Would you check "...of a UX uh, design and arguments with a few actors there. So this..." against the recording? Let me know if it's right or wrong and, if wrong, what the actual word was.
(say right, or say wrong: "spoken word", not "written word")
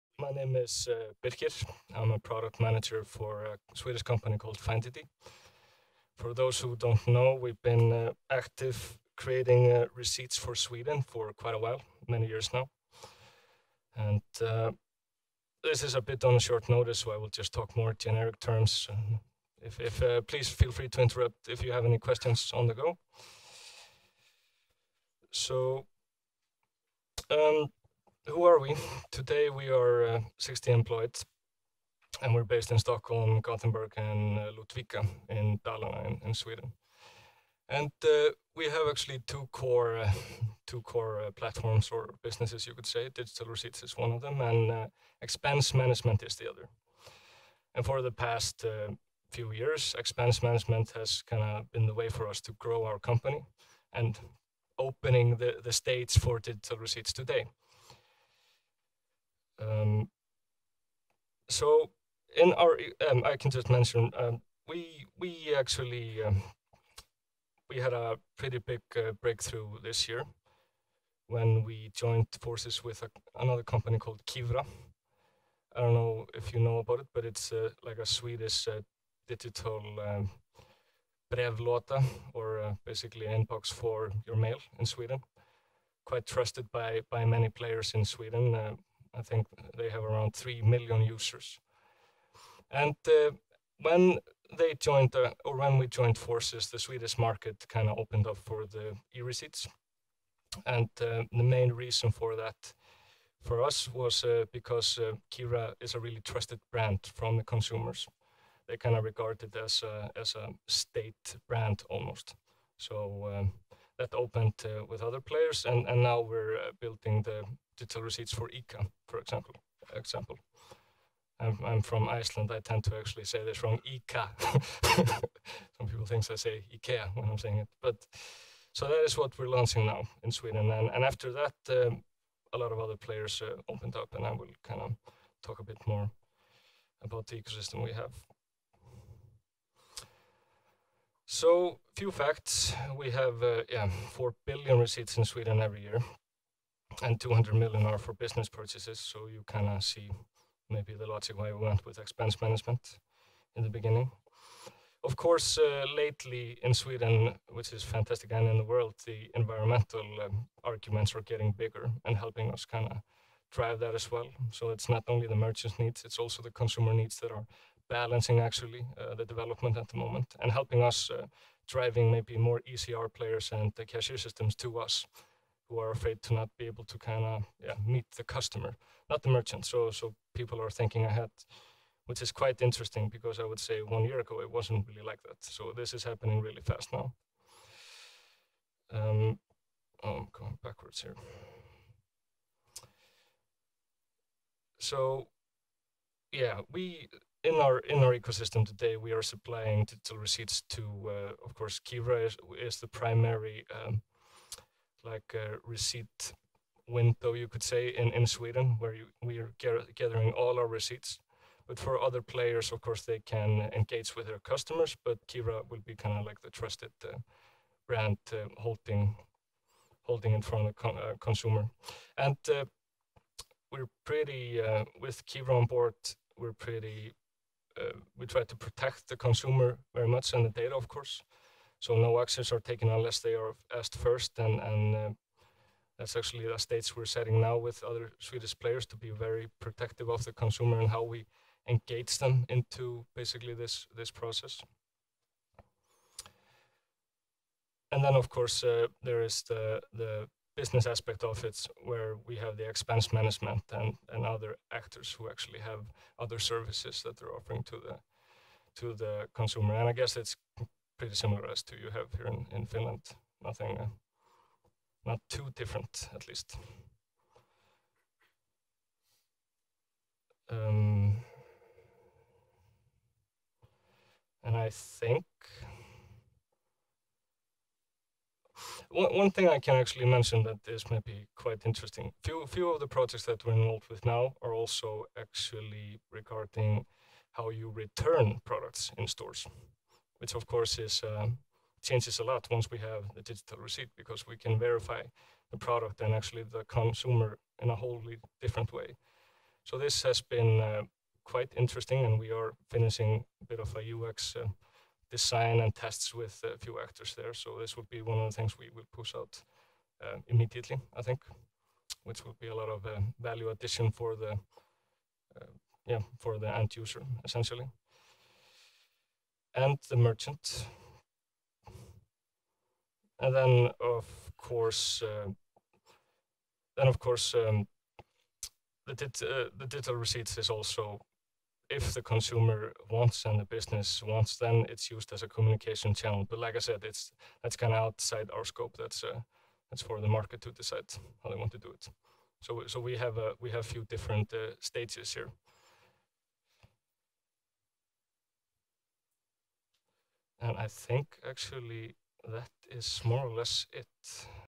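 wrong: "tests", not "arguments".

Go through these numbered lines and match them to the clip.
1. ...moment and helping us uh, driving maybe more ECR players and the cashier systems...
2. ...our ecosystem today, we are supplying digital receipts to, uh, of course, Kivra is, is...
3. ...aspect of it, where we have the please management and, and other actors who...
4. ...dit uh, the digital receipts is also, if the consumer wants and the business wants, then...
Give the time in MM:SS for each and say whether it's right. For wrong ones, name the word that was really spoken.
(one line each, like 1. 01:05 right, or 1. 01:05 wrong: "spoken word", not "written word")
1. 02:49 right
2. 03:18 right
3. 04:10 wrong: "expense", not "please"
4. 05:28 right.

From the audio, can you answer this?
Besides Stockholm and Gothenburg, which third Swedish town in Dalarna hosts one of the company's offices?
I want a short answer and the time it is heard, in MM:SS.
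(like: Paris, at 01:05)
Ludvika, at 00:34.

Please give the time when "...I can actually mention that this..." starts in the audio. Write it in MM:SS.
04:39.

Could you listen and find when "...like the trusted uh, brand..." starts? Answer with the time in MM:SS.
03:36.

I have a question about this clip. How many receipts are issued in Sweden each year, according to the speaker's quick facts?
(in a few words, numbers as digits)
4 billion.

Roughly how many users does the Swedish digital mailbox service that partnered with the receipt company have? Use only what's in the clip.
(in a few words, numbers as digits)
3 million.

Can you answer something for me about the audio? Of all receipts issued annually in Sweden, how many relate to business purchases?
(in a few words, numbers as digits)
200 million.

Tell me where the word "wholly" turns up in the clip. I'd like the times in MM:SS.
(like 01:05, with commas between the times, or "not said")
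04:57.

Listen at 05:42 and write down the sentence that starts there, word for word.
So so we have a uh, we have few different uh, stages here.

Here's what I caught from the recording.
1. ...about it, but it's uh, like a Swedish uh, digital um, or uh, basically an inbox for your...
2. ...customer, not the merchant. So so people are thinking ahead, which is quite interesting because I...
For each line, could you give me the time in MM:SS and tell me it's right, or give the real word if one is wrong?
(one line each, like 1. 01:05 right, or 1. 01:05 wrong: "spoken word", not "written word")
1. 01:16 right
2. 02:58 right.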